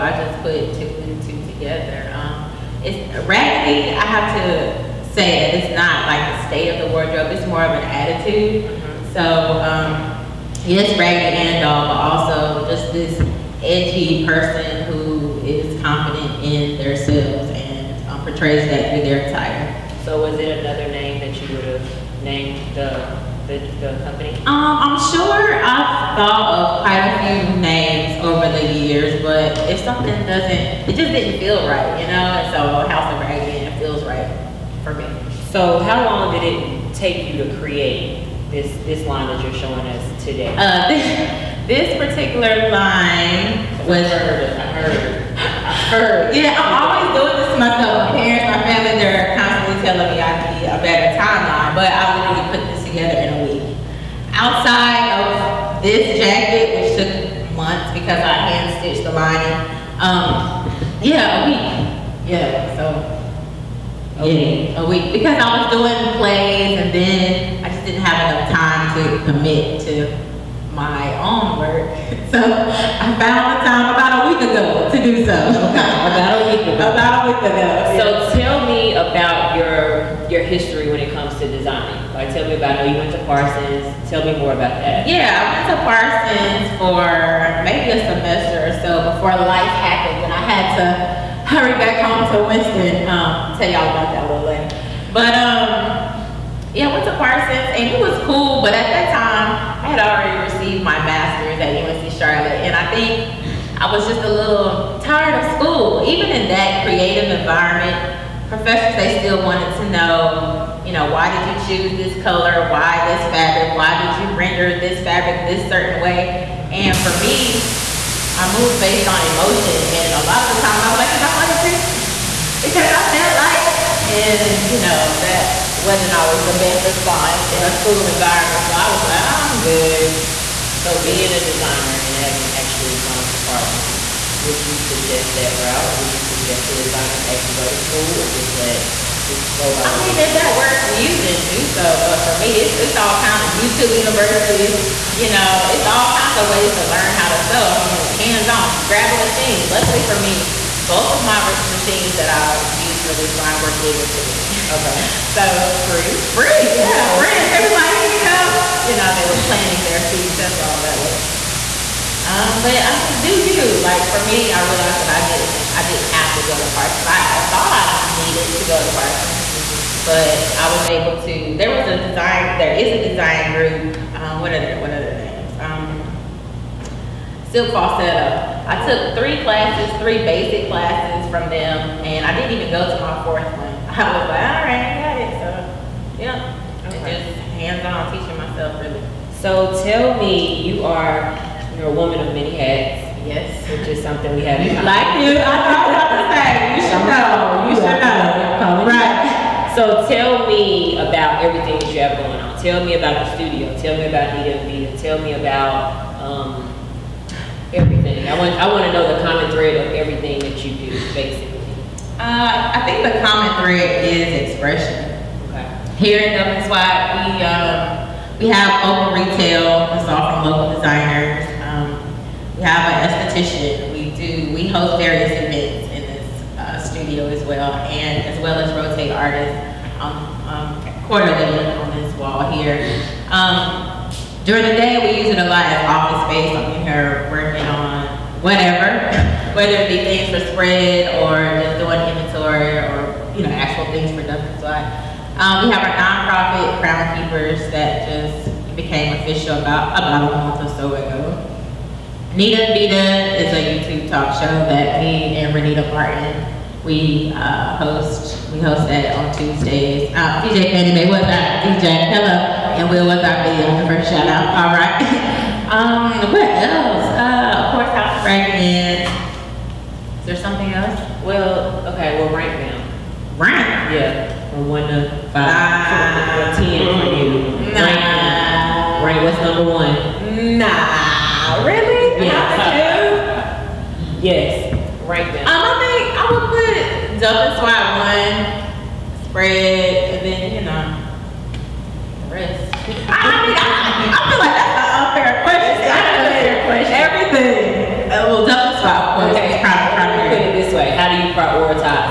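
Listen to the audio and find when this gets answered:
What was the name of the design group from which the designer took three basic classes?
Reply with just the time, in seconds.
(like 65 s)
177 s.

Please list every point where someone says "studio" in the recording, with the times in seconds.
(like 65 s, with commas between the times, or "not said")
203 s, 226 s.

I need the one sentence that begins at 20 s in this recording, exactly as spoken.
So was it another name that you would have named the the company?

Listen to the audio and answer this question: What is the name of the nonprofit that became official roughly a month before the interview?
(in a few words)
Crown Keepers.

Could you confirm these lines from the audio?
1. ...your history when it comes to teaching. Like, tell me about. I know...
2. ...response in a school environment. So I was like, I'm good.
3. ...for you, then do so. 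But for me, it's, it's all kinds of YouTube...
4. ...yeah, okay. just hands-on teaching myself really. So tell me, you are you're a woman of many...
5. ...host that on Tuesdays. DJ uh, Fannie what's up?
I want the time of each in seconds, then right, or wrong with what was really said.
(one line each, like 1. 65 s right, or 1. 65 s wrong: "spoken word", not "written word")
1. 80 s wrong: "designing", not "teaching"
2. 126 s right
3. 140 s right
4. 186 s right
5. 258 s right.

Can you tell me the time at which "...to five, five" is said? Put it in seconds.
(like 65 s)
274 s.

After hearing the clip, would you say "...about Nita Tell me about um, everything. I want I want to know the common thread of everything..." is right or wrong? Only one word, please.
right.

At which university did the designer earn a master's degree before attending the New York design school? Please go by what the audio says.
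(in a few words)
UNC Charlotte.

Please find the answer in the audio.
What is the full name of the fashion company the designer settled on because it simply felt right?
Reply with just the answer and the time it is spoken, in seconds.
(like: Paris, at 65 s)
House of Raggedy Anne, at 32 s.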